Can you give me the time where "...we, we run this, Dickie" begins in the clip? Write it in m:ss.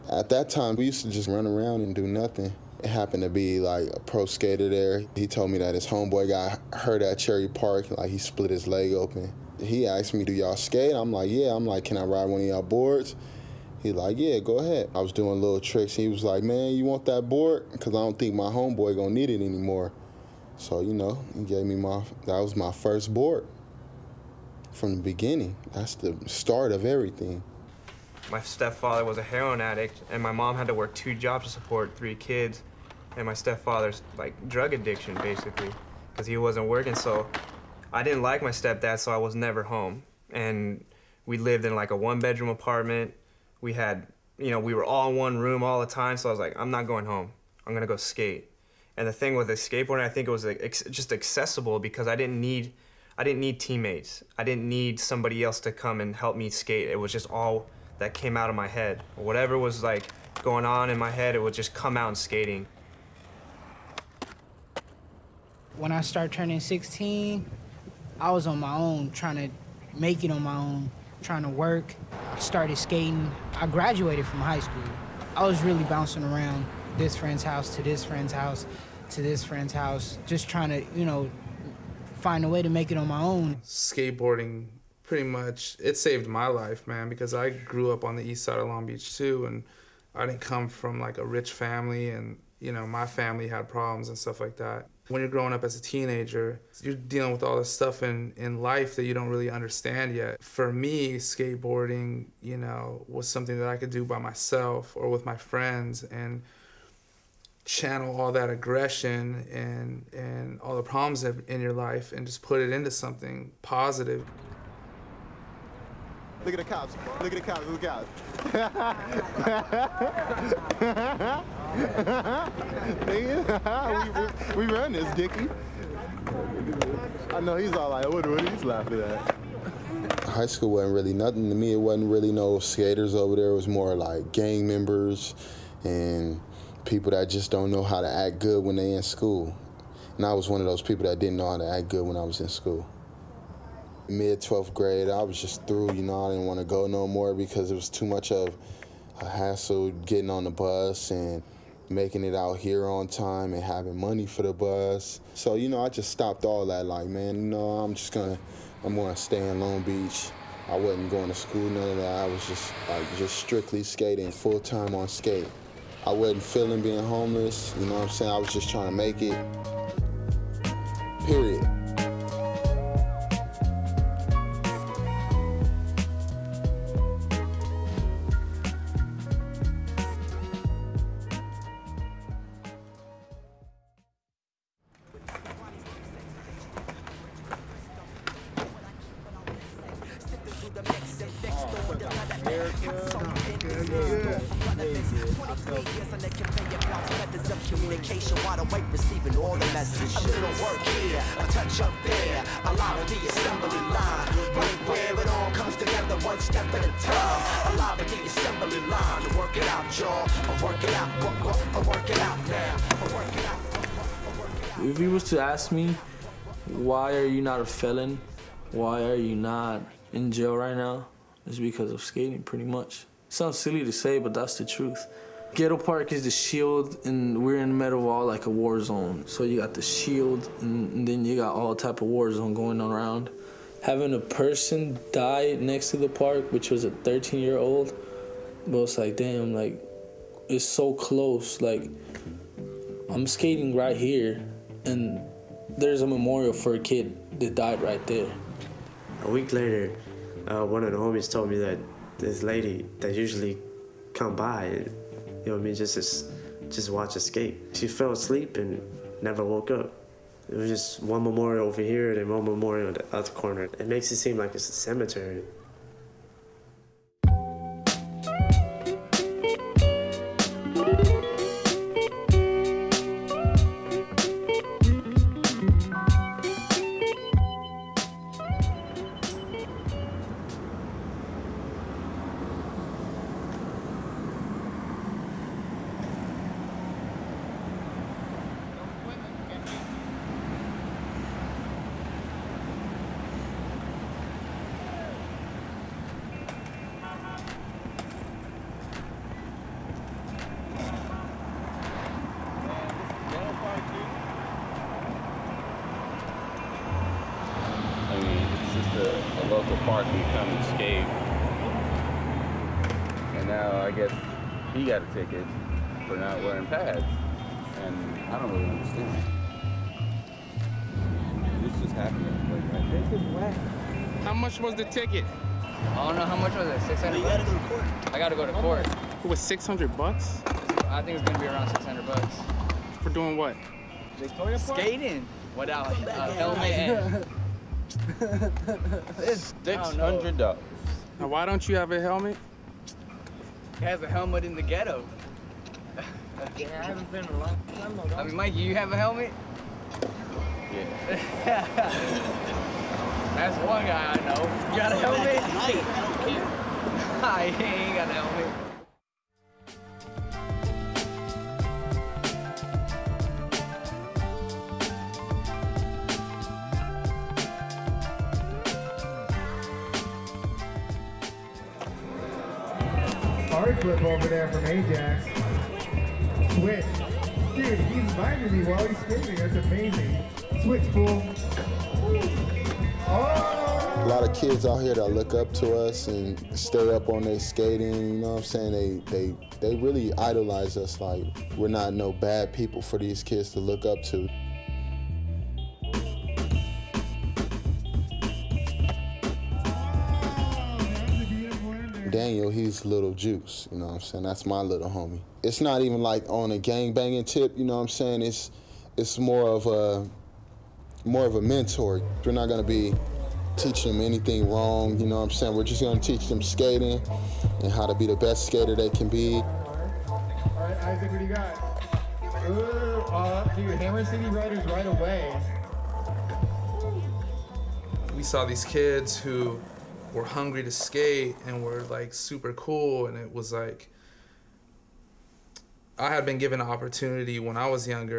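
2:04.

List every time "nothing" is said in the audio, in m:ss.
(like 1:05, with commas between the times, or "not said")
0:02, 2:11.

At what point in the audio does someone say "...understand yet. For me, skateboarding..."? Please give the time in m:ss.
1:39.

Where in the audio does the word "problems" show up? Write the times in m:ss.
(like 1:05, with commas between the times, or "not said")
1:33, 1:50.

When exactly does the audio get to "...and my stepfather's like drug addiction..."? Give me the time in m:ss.
0:33.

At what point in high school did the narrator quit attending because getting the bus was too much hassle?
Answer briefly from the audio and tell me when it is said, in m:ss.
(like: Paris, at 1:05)
Mid 12th grade, at 2:24.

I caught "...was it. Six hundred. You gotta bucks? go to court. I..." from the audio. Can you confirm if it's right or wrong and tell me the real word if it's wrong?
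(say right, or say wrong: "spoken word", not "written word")
right.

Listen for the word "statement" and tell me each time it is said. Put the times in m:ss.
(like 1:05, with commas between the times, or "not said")
not said.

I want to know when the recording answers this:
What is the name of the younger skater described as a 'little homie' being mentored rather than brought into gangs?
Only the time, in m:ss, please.
6:42.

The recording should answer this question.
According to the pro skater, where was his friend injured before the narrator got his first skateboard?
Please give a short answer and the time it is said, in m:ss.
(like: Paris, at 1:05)
Cherry Park, at 0:07.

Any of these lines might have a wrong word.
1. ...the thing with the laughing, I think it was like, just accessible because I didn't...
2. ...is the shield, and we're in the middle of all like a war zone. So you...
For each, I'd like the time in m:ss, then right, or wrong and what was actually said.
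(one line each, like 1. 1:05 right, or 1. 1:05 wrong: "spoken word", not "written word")
1. 0:49 wrong: "skateboarding", not "laughing"
2. 3:46 right.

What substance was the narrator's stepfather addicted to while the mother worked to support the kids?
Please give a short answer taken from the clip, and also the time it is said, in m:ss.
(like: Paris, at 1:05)
Heroin, at 0:29.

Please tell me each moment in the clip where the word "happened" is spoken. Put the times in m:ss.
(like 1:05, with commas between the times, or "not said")
0:02, 5:21.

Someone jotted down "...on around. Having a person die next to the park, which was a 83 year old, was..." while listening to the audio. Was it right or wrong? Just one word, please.
wrong.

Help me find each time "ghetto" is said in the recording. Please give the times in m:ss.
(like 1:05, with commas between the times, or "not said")
3:45, 5:44.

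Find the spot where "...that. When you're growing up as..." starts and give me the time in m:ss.
1:34.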